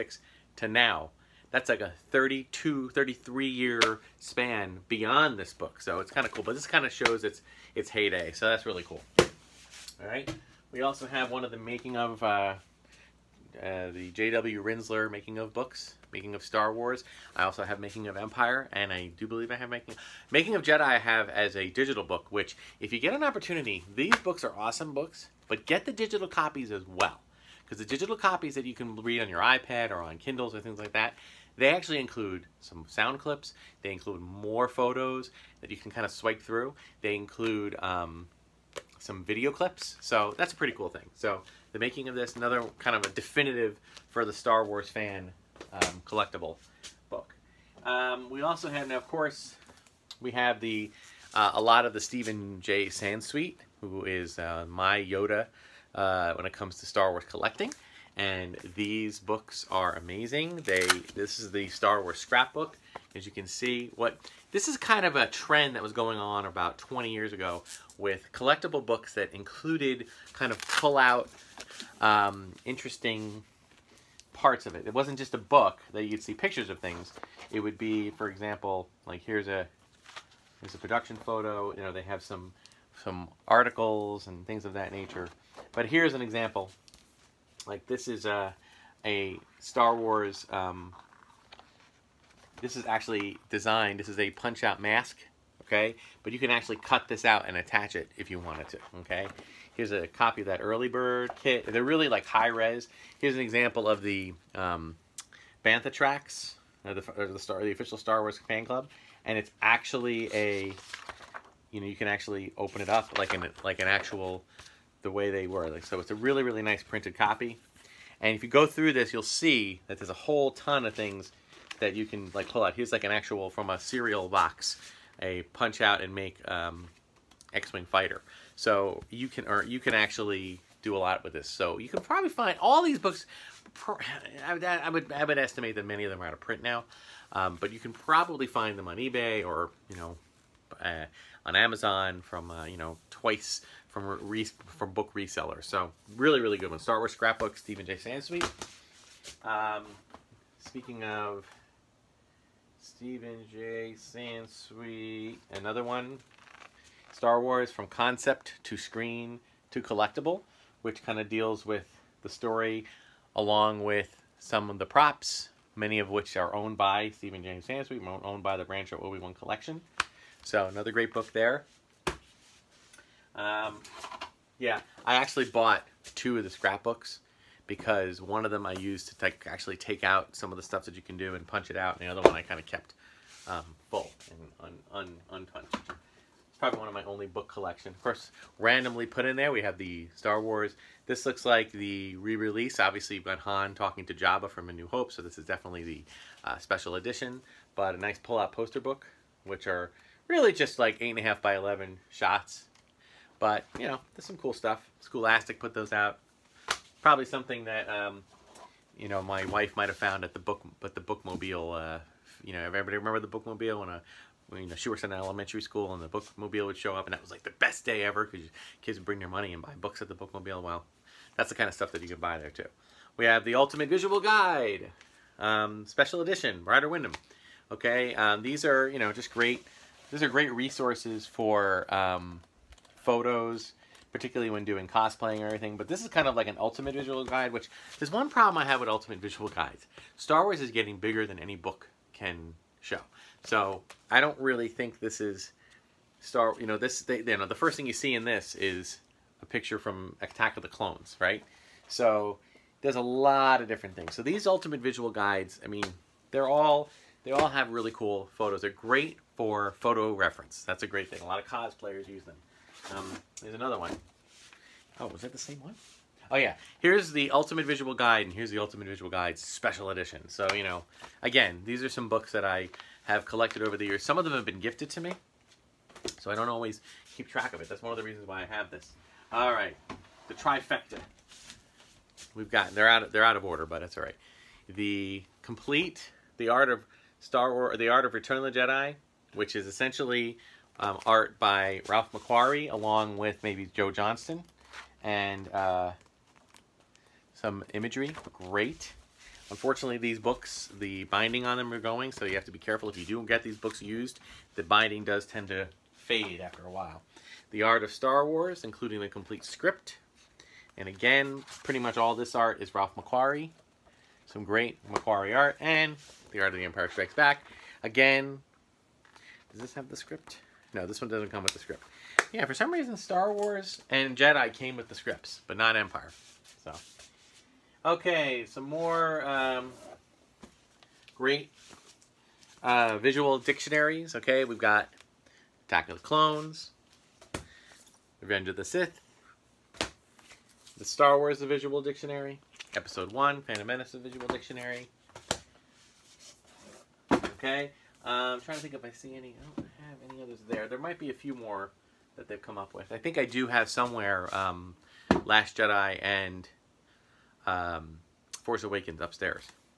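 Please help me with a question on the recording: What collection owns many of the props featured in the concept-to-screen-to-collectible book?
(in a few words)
Rancho Obi-Wan Collection.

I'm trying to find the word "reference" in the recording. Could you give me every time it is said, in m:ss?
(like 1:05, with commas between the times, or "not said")
4:20.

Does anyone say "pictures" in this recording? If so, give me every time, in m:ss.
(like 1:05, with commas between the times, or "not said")
1:16, 4:09.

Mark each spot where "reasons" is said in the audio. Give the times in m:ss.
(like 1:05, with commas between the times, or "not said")
4:38, 5:22.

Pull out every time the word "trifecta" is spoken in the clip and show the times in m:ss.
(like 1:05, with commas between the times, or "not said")
4:40.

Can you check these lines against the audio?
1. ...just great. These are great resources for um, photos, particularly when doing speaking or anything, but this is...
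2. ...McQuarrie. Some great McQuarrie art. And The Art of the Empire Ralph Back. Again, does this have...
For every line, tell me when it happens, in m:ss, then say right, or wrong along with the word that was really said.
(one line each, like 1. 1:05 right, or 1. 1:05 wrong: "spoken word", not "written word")
1. 3:49 wrong: "cosplaying", not "speaking"
2. 5:12 wrong: "Strikes", not "Ralph".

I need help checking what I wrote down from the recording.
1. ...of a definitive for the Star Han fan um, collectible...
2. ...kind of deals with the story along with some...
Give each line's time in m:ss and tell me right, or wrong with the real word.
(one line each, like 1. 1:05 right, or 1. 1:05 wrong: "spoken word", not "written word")
1. 0:42 wrong: "Wars", not "Han"
2. 2:41 right.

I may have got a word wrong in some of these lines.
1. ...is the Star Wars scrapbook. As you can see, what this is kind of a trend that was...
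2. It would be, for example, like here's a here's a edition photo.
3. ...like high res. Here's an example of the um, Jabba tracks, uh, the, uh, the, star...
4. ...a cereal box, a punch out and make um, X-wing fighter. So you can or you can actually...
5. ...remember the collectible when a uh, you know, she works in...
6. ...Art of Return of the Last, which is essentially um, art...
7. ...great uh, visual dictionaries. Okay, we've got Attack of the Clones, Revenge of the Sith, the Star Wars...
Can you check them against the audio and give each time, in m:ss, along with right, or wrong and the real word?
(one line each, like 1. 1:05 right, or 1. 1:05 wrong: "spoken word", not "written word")
1. 1:01 right
2. 1:17 wrong: "production", not "edition"
3. 1:42 wrong: "Bantha", not "Jabba"
4. 2:03 right
5. 3:32 wrong: "bookmobile", not "collectible"
6. 4:47 wrong: "Jedi", not "Last"
7. 5:31 right.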